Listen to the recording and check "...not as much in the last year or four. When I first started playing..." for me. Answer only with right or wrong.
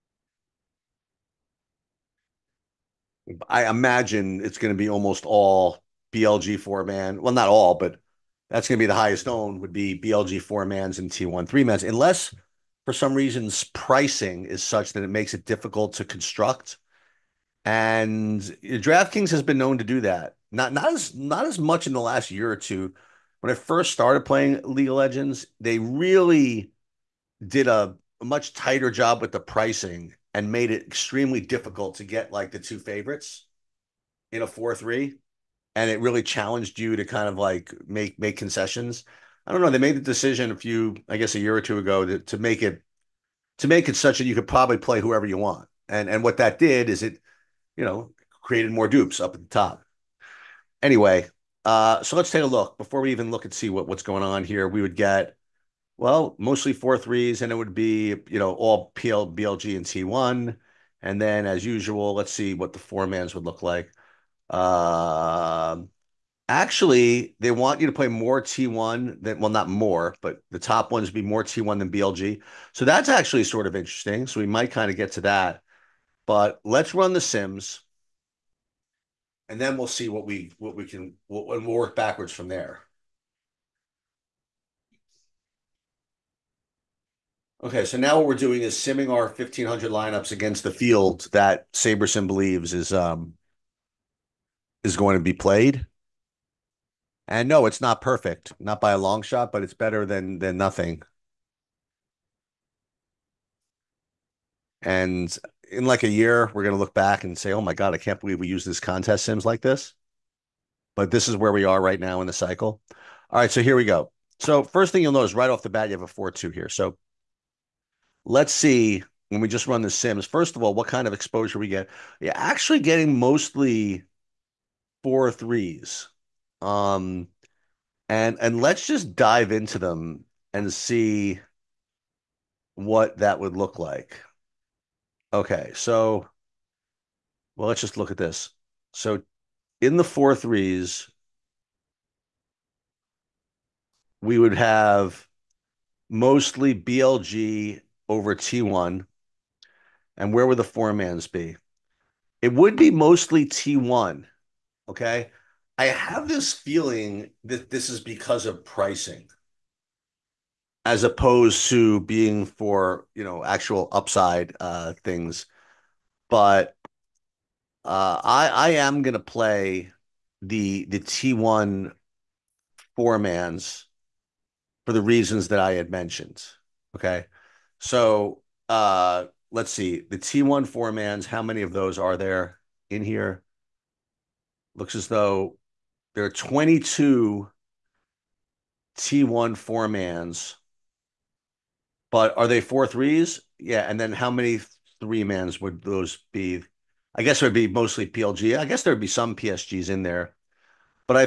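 wrong.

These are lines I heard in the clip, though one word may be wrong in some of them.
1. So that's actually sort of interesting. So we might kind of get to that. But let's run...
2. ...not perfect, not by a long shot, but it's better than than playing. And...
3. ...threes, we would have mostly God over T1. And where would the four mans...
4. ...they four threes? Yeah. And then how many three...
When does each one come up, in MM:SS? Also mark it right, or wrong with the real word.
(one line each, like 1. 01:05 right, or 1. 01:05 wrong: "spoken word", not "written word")
1. 01:12 right
2. 01:37 wrong: "nothing", not "playing"
3. 02:20 wrong: "BLG", not "God"
4. 03:12 right.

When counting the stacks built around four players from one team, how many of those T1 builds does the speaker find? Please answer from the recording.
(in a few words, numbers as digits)
22.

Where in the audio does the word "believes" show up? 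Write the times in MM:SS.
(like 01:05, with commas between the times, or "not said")
01:32, 01:48.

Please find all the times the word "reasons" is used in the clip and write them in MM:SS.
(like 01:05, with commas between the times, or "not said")
00:13, 02:55.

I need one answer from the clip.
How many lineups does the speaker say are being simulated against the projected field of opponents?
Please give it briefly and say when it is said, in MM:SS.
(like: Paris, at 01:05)
1500, at 01:29.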